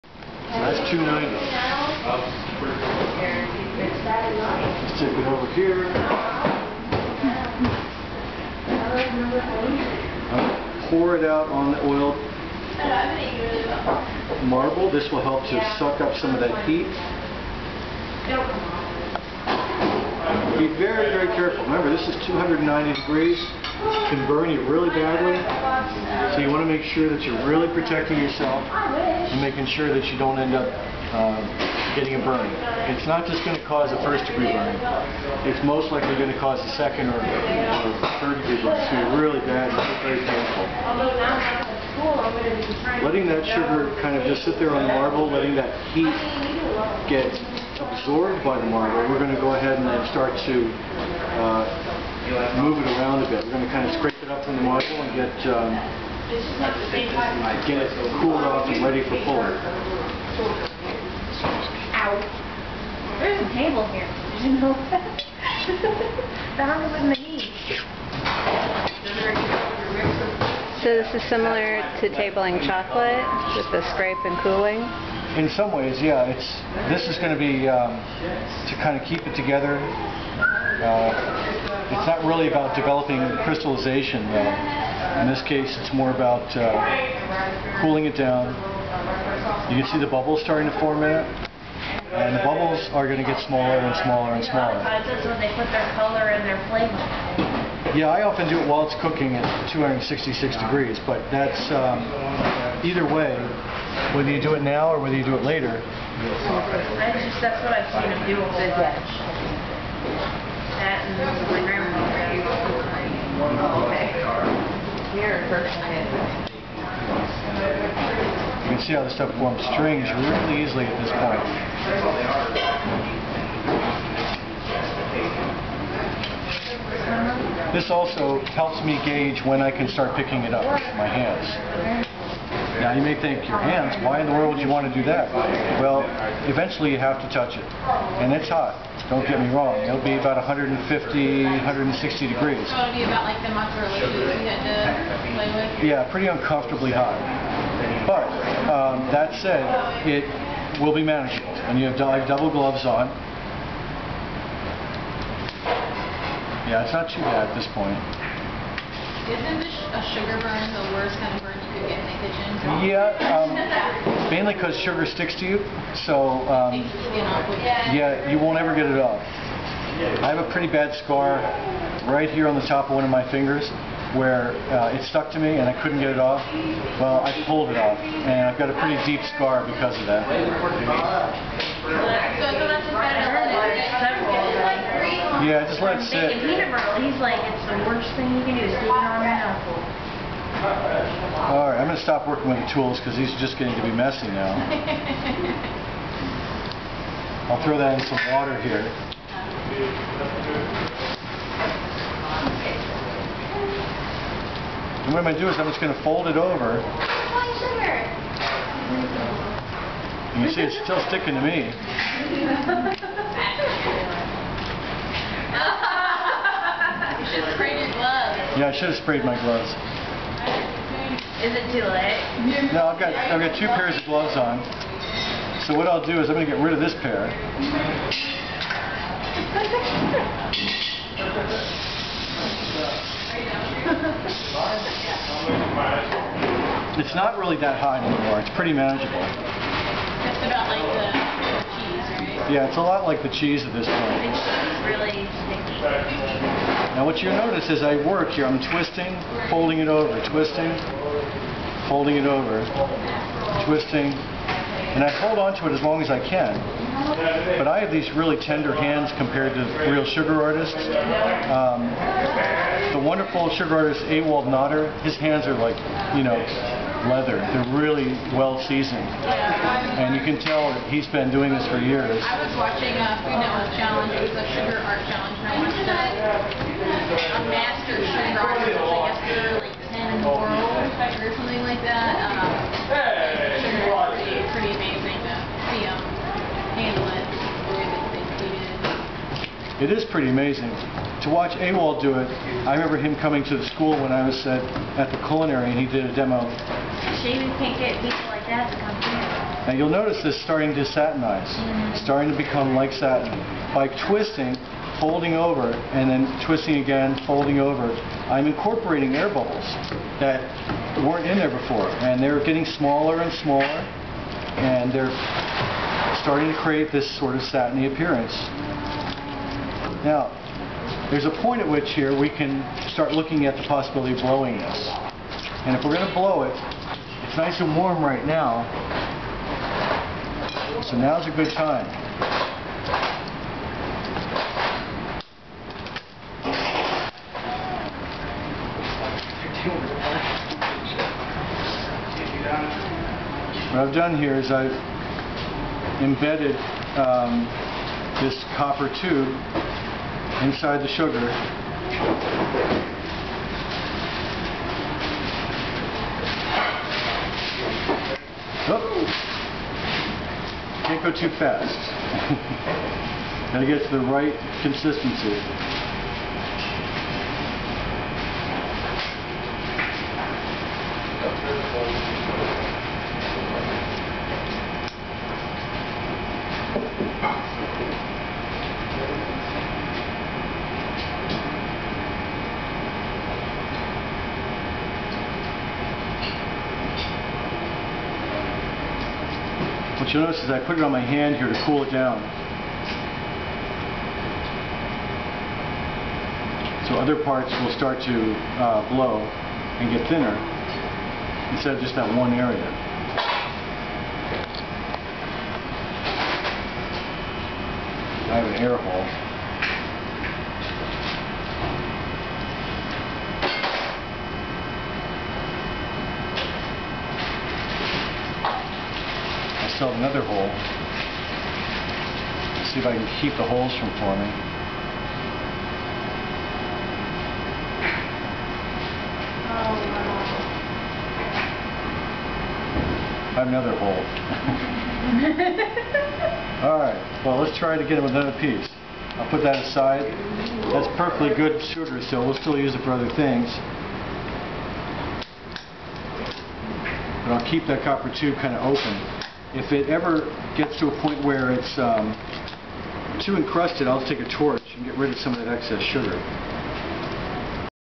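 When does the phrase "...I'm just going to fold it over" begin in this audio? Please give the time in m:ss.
3:25.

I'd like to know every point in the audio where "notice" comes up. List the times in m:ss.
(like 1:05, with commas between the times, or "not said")
4:07, 4:59, 6:30.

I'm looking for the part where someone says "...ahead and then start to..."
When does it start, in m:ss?
0:49.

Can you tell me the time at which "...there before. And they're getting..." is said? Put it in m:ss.
5:11.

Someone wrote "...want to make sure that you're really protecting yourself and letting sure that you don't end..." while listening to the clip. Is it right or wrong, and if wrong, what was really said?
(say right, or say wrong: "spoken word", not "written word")
wrong: "making", not "letting".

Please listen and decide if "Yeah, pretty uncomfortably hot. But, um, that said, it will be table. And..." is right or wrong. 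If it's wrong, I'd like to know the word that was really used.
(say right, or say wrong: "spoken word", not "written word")
wrong: "manageable", not "table".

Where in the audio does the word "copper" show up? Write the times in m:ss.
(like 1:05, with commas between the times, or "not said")
5:48, 7:27.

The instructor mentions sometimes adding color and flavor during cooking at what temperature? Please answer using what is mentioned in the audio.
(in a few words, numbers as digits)
266 degrees.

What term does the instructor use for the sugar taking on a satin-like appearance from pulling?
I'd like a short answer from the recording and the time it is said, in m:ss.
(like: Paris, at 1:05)
satinize, at 5:00.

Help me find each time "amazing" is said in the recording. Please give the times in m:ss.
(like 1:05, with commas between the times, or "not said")
4:44, 4:50.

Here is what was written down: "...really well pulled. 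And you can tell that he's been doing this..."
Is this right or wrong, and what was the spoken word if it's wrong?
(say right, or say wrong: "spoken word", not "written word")
wrong: "seasoned", not "pulled".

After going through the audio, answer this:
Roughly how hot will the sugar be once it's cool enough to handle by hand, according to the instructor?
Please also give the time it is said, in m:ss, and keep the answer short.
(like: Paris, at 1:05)
150 to 160 degrees, at 2:20.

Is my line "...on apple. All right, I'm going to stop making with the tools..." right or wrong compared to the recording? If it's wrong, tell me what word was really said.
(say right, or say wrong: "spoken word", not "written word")
wrong: "working", not "making".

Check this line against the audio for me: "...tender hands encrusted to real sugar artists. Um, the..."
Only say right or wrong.
wrong.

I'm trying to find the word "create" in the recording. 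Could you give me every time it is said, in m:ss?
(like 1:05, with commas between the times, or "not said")
5:16.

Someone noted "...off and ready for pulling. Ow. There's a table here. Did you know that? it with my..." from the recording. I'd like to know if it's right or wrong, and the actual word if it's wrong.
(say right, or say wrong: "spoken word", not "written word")
right.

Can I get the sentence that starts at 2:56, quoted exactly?
Well, I pulled it off, and I've got a pretty deep scar because of that.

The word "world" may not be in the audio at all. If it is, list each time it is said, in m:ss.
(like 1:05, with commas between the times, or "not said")
2:14, 4:40.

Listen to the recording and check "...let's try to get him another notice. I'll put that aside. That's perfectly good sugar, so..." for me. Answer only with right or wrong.
wrong.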